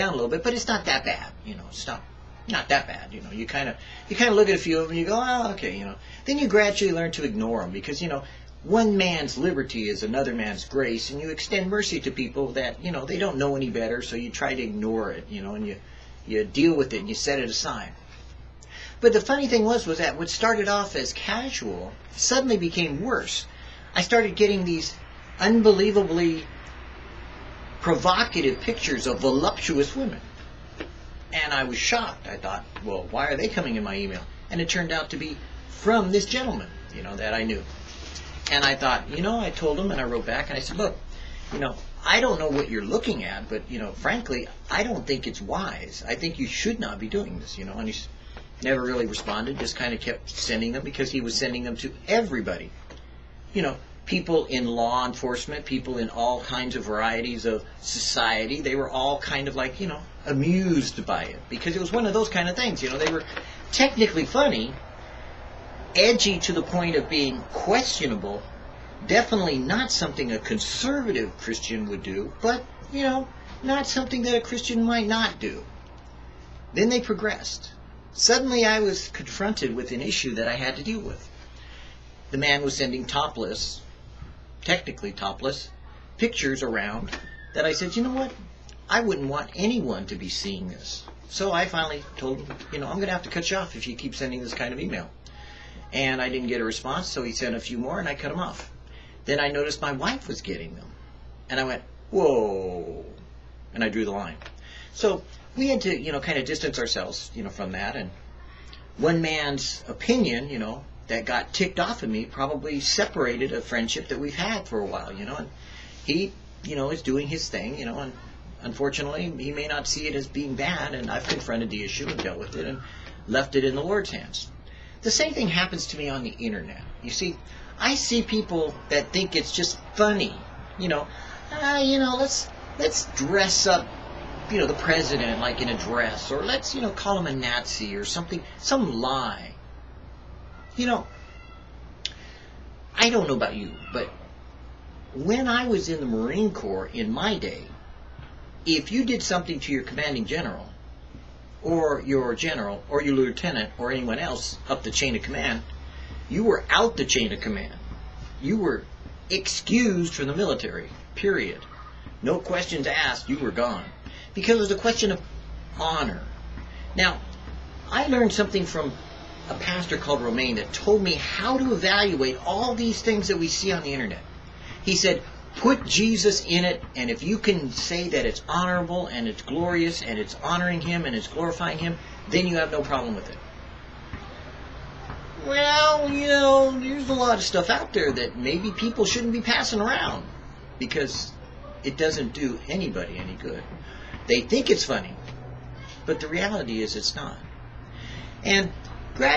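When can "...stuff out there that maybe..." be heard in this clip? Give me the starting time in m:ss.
3:07.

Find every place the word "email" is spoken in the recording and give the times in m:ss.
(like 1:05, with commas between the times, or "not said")
0:33, 1:34.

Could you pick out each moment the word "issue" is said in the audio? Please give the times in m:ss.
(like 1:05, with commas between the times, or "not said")
1:20, 2:01.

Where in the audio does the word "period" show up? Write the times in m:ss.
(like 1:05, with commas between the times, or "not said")
2:41.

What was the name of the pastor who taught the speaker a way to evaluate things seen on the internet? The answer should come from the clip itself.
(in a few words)
Romaine.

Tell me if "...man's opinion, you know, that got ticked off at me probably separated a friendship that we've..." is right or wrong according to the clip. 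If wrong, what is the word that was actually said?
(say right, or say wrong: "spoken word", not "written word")
right.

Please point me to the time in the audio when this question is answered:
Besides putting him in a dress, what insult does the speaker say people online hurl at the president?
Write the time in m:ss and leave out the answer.
2:17.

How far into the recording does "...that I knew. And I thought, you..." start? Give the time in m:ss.
0:37.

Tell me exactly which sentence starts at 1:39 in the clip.
Then I noticed my wife was getting them.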